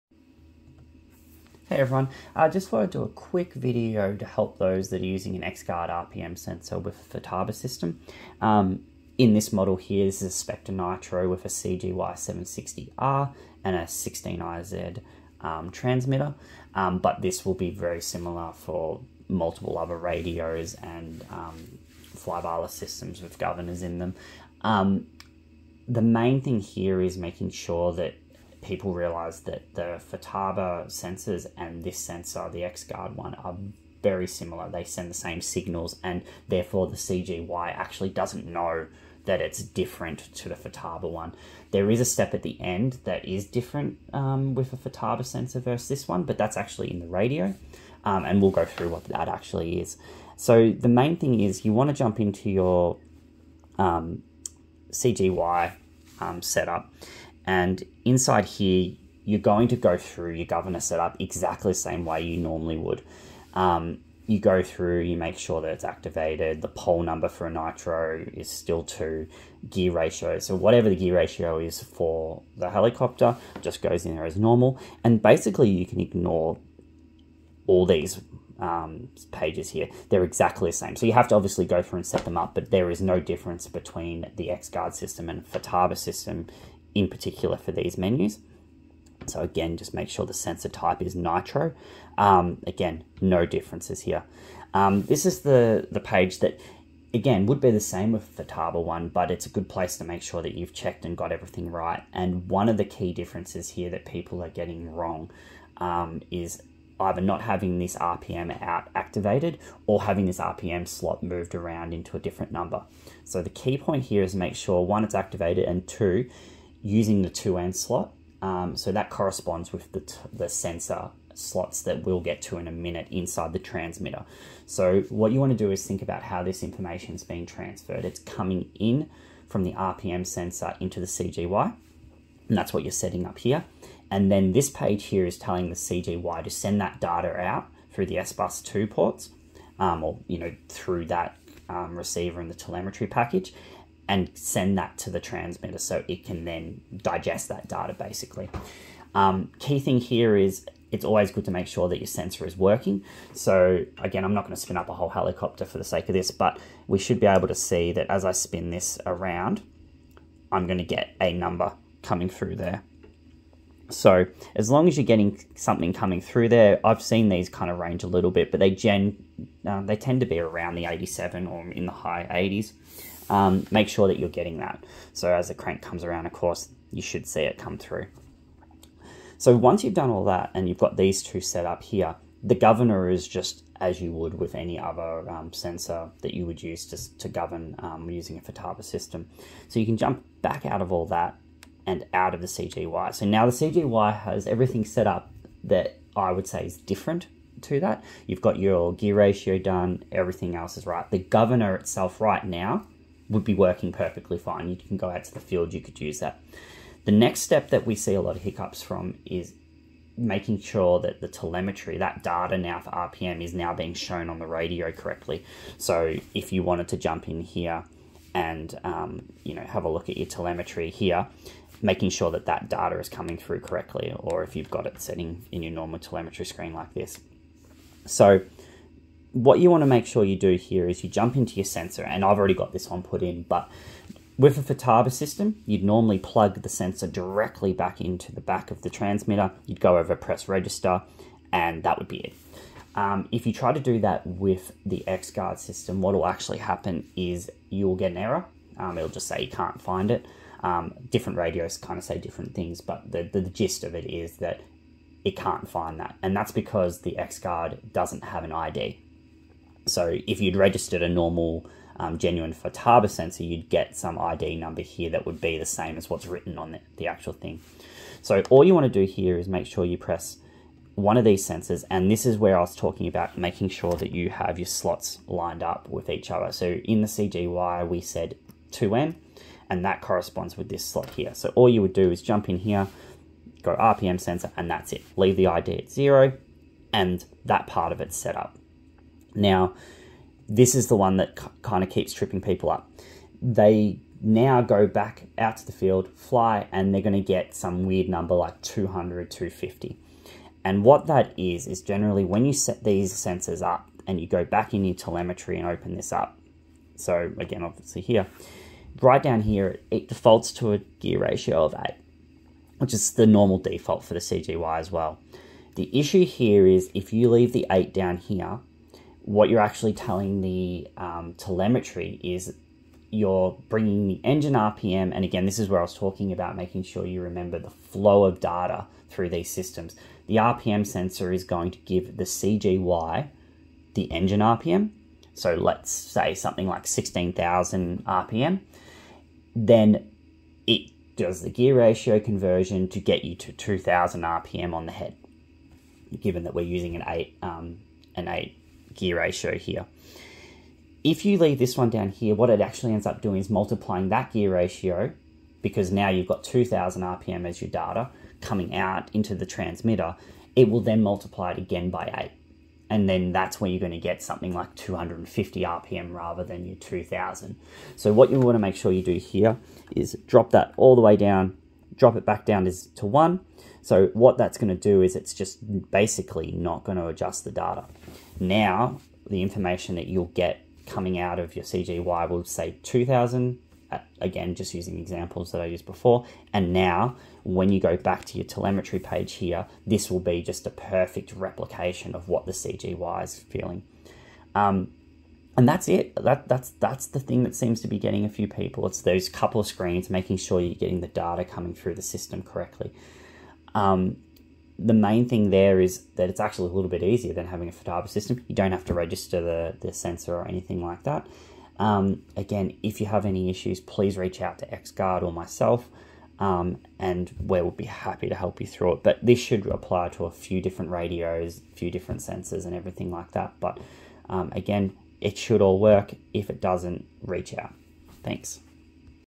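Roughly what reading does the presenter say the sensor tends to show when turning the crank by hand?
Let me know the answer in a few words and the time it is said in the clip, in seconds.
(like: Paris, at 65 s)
High 80s, at 171 s.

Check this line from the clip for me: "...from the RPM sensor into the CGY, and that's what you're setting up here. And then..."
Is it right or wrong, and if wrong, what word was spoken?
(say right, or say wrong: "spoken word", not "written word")
right.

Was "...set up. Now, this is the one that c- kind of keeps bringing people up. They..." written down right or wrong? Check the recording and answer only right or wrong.
wrong.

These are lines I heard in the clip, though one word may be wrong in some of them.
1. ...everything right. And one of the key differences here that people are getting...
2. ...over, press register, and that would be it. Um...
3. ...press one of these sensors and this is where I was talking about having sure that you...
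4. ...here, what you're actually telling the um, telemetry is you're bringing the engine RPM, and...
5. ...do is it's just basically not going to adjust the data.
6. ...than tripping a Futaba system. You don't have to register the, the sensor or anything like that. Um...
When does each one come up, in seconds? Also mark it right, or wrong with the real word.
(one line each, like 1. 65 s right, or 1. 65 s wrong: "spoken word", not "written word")
1. 101 s right
2. 239 s right
3. 269 s wrong: "making", not "having"
4. 318 s right
5. 374 s right
6. 407 s wrong: "having", not "tripping".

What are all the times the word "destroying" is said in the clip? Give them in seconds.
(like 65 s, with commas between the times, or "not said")
not said.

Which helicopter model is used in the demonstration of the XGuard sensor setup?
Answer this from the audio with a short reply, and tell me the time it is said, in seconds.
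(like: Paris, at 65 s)
Spectre Nitro, at 10 s.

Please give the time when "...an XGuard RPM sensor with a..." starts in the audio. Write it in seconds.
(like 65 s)
5 s.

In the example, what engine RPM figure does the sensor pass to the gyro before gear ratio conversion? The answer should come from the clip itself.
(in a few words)
16,000 RPM.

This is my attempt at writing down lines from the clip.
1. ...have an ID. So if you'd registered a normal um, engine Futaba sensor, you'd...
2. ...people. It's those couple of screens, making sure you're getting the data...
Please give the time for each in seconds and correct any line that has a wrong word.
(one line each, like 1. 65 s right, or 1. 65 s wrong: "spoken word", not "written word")
1. 258 s wrong: "genuine", not "engine"
2. 398 s right.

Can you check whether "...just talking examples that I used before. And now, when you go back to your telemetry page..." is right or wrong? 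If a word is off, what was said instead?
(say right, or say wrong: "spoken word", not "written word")
wrong: "using", not "talking".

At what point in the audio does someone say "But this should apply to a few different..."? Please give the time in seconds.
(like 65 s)
419 s.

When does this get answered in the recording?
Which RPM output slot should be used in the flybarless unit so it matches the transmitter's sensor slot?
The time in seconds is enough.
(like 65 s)
117 s.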